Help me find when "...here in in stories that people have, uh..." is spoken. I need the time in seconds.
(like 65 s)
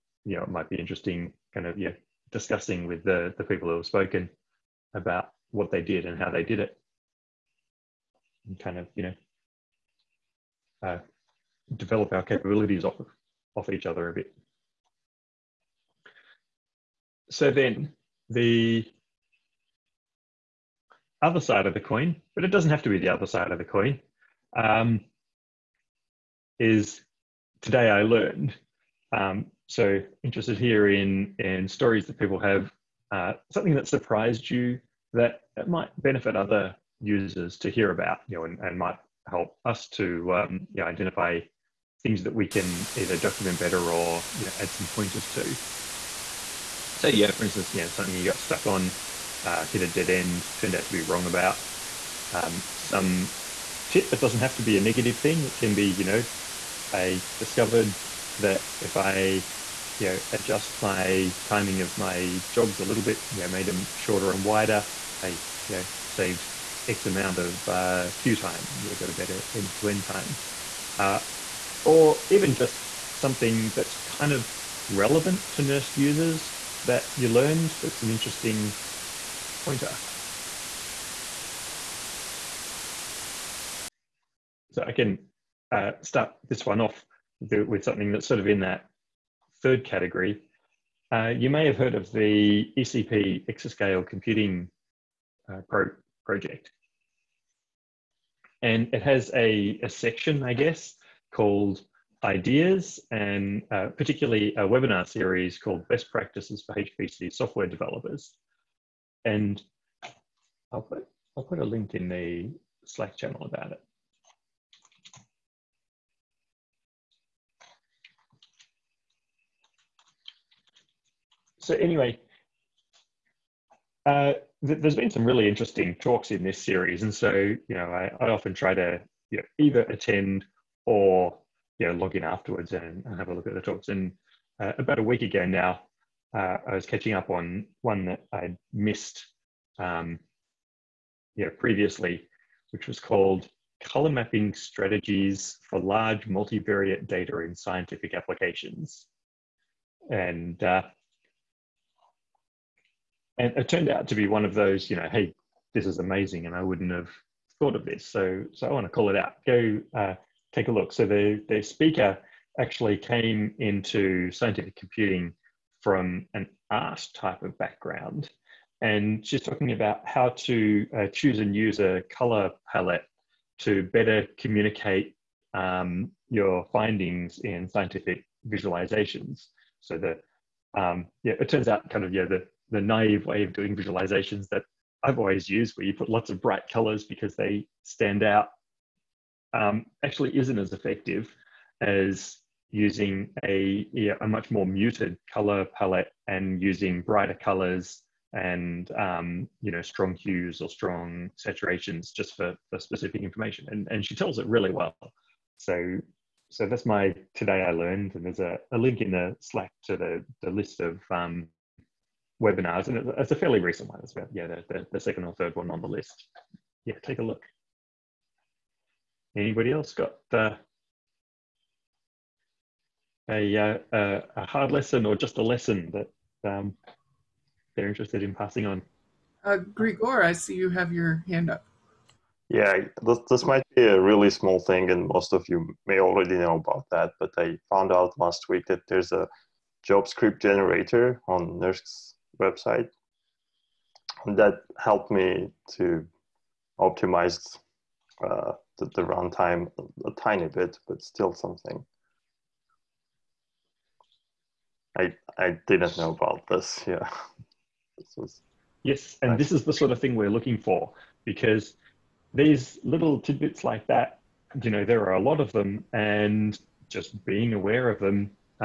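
30 s.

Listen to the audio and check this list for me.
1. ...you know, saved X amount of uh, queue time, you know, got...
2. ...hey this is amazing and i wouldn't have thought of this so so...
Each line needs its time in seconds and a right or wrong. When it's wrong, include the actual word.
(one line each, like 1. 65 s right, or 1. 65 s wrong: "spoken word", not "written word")
1. 65 s right
2. 155 s right.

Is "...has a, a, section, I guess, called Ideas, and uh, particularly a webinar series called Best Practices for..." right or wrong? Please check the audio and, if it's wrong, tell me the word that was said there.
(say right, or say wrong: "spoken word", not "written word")
right.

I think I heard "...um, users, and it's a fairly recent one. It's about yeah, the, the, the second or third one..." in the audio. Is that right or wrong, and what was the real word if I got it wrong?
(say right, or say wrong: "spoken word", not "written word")
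wrong: "webinars", not "users".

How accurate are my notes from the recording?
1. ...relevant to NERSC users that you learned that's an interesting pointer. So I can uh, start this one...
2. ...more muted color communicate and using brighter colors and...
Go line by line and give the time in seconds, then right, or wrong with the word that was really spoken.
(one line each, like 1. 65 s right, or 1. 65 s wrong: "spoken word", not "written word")
1. 74 s right
2. 194 s wrong: "palette", not "communicate".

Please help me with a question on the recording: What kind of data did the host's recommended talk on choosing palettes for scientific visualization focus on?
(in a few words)
Large multivariate data.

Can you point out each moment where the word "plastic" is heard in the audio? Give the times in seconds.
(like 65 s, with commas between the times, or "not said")
not said.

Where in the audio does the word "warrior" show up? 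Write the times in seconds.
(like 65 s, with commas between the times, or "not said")
not said.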